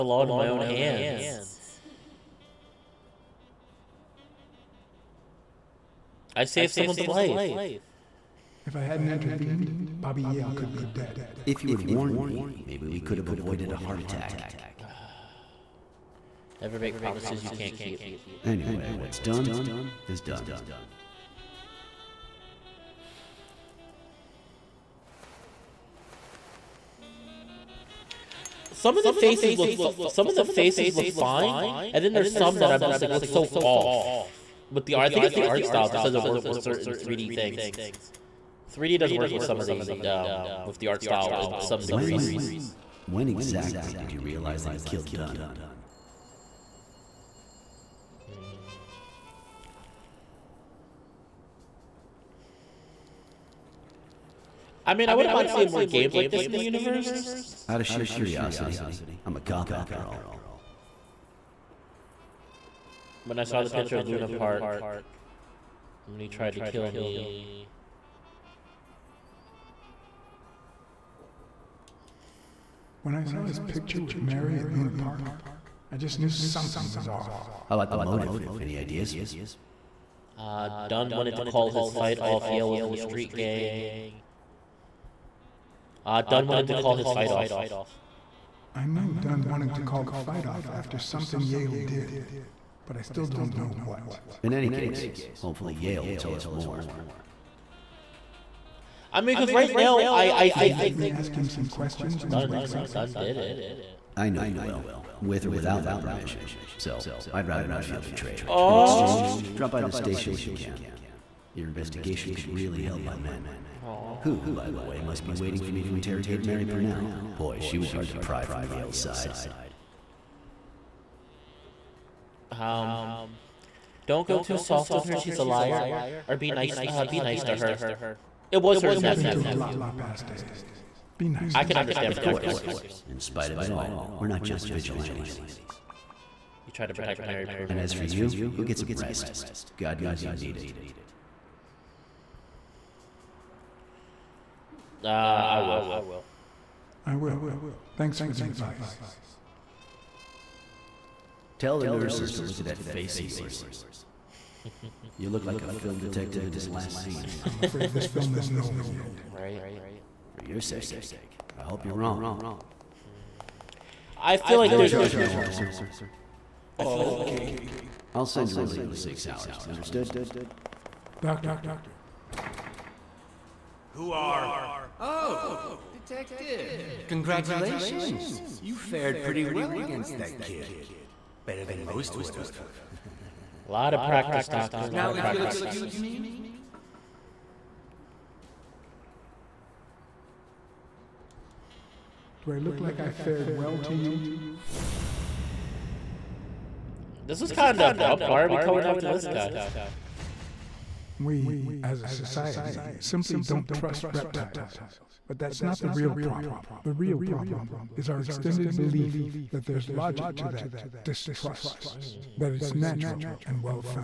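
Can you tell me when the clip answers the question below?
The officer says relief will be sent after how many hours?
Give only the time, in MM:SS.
02:48.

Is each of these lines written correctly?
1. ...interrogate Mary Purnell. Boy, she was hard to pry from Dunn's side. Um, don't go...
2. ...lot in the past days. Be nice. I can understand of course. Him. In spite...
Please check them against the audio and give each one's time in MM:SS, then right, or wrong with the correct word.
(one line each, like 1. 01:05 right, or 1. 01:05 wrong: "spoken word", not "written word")
1. 01:55 wrong: "Yale", not "Dunn"
2. 02:09 right.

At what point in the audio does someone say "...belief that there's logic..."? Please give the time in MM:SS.
03:28.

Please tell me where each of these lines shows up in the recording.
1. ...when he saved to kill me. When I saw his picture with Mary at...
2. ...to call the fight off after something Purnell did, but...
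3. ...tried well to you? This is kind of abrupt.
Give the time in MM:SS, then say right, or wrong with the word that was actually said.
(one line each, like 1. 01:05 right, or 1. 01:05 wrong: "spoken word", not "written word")
1. 01:06 wrong: "tried", not "saved"
2. 01:29 wrong: "Yale", not "Purnell"
3. 03:13 wrong: "fared", not "tried".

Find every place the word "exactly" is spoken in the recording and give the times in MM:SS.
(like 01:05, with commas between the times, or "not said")
00:43.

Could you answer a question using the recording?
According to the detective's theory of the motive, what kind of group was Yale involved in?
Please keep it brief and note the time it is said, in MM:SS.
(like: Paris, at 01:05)
street gang, at 01:22.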